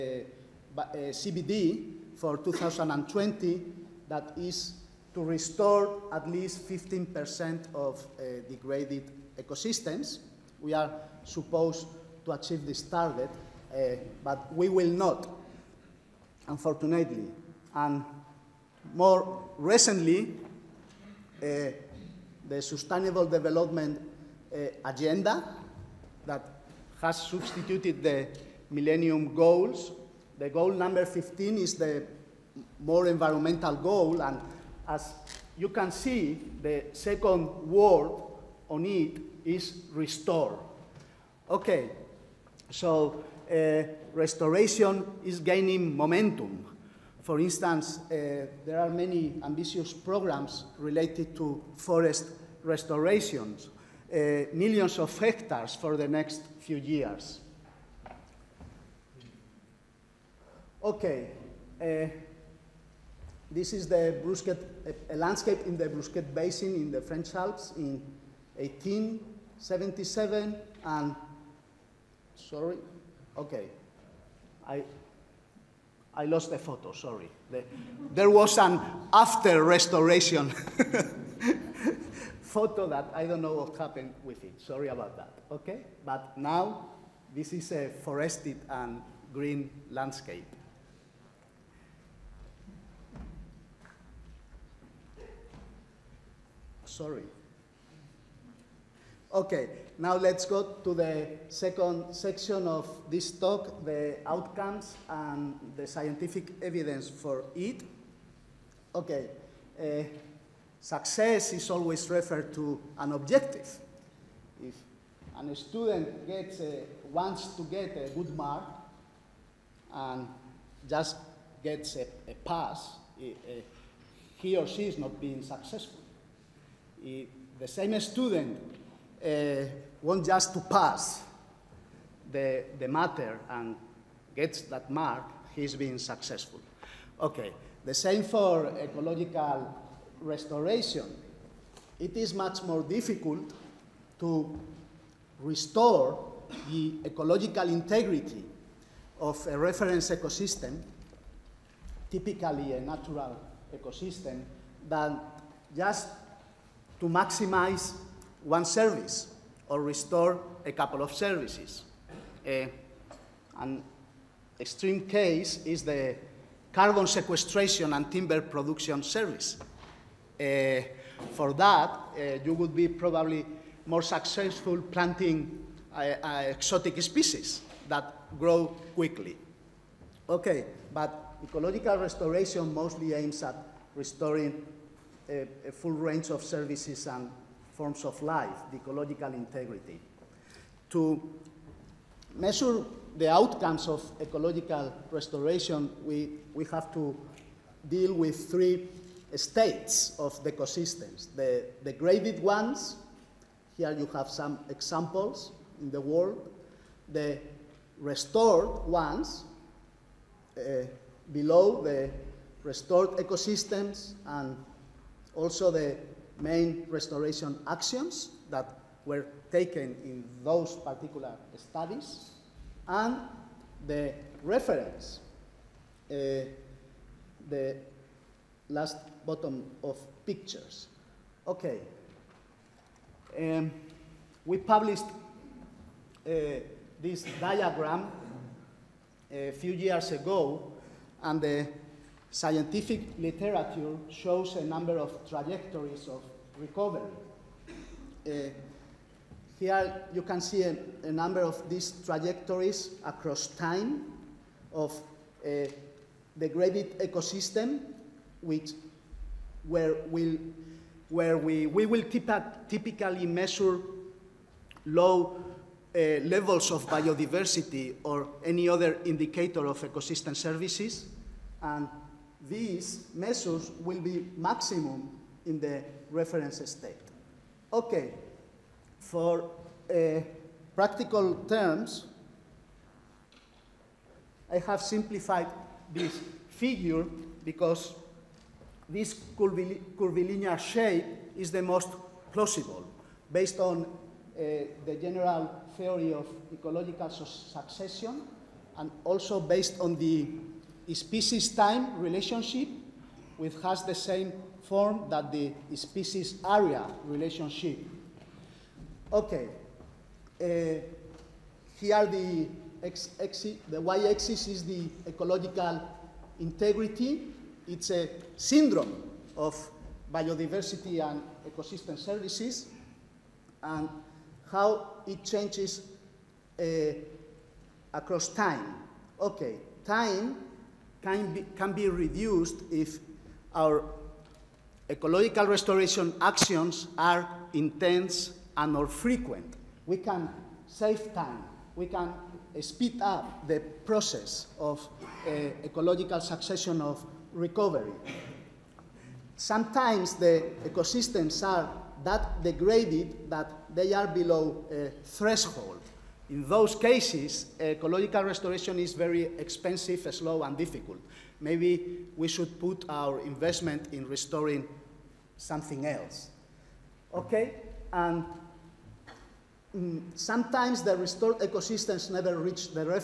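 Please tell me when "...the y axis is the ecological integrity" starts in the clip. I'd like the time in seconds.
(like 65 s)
313 s.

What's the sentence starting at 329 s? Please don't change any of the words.
Okay, time can be, can be reduced if our ecological restoration actions are intense and more frequent.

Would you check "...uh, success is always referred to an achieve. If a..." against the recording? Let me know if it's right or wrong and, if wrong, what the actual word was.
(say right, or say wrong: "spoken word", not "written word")
wrong: "objective", not "achieve".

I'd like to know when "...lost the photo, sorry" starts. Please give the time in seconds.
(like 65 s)
76 s.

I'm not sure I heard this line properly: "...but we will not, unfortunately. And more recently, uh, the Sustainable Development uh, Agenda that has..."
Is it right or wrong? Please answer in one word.
right.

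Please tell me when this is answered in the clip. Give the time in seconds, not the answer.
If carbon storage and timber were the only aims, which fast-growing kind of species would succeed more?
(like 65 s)
176 s.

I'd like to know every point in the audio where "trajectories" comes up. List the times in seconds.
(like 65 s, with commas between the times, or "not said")
245 s, 252 s.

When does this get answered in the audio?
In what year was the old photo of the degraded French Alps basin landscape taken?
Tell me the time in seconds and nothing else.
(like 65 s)
68 s.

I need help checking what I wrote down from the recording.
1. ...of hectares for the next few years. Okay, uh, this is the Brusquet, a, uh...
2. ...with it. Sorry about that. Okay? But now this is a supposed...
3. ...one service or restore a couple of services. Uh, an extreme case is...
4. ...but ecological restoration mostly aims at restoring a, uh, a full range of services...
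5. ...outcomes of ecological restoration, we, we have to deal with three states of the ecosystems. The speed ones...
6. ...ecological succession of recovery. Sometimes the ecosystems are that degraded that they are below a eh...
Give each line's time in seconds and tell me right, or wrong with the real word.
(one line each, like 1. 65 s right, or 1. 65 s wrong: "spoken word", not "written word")
1. 54 s right
2. 84 s wrong: "forested", not "supposed"
3. 158 s right
4. 180 s right
5. 193 s wrong: "degraded", not "speed"
6. 345 s right.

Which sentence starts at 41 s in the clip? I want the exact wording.
Okay, so uh, restoration is gaining momentum.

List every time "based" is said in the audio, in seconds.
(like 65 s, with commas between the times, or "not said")
293 s, 299 s.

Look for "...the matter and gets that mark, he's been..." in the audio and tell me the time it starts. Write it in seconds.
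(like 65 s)
132 s.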